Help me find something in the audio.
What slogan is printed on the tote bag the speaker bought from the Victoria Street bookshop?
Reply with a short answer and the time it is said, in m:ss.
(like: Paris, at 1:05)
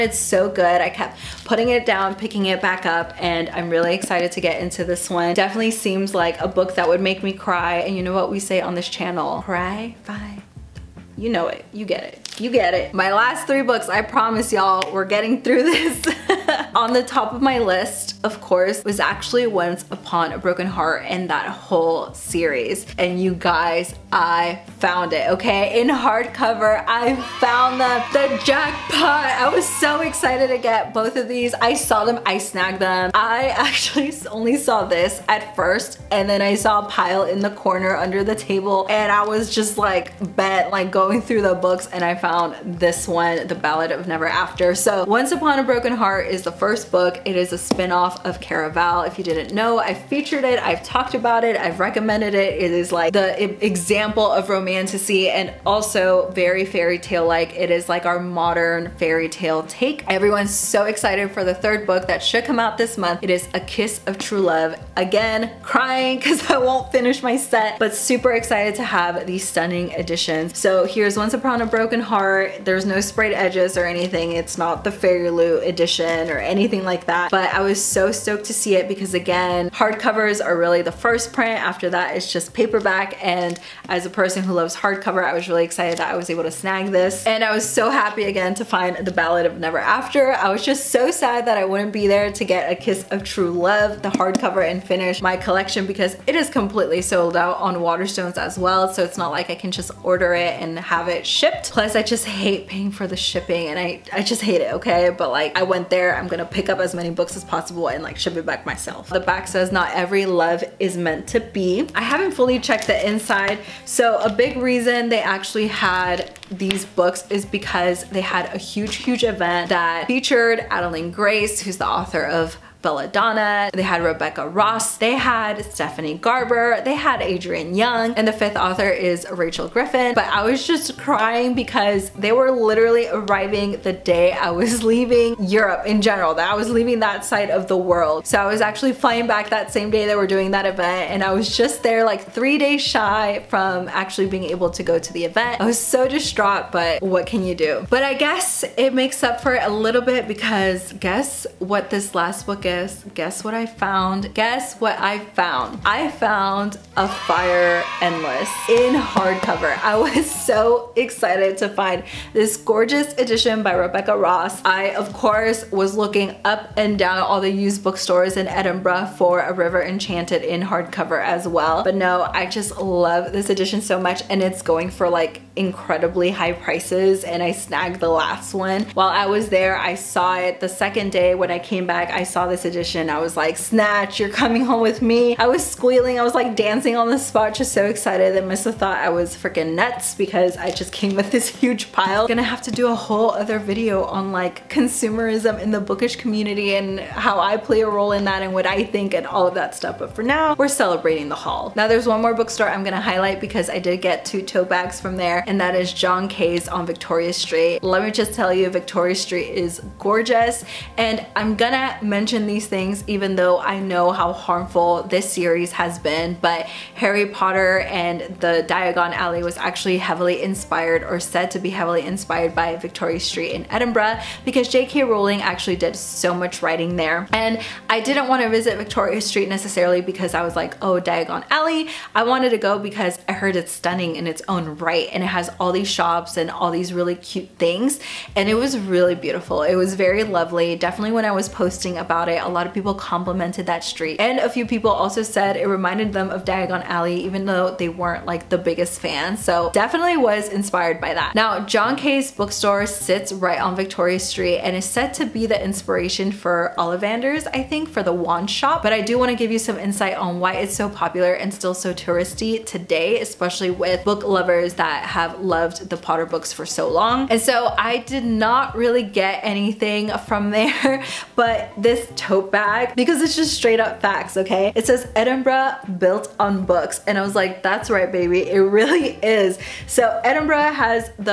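Edinburgh built on books, at 4:35.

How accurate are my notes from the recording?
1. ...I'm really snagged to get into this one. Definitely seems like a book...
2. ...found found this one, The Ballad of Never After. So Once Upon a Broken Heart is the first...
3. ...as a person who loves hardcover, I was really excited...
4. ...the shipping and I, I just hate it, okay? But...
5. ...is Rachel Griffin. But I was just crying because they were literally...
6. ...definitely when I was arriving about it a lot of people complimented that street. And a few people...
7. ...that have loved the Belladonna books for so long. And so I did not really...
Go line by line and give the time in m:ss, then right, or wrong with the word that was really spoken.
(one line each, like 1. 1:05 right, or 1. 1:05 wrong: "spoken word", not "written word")
1. 0:03 wrong: "excited", not "snagged"
2. 0:42 right
3. 1:23 right
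4. 1:43 right
5. 2:08 right
6. 4:00 wrong: "posting", not "arriving"
7. 4:24 wrong: "Potter", not "Belladonna".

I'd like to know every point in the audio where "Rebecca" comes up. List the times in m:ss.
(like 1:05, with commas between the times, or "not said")
2:04, 2:43.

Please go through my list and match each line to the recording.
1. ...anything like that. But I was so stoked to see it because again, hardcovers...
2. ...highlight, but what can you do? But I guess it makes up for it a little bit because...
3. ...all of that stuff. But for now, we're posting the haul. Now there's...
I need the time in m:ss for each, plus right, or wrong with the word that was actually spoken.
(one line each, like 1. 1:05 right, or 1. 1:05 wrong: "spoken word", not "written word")
1. 1:16 right
2. 2:26 wrong: "distraught", not "highlight"
3. 3:19 wrong: "celebrating", not "posting".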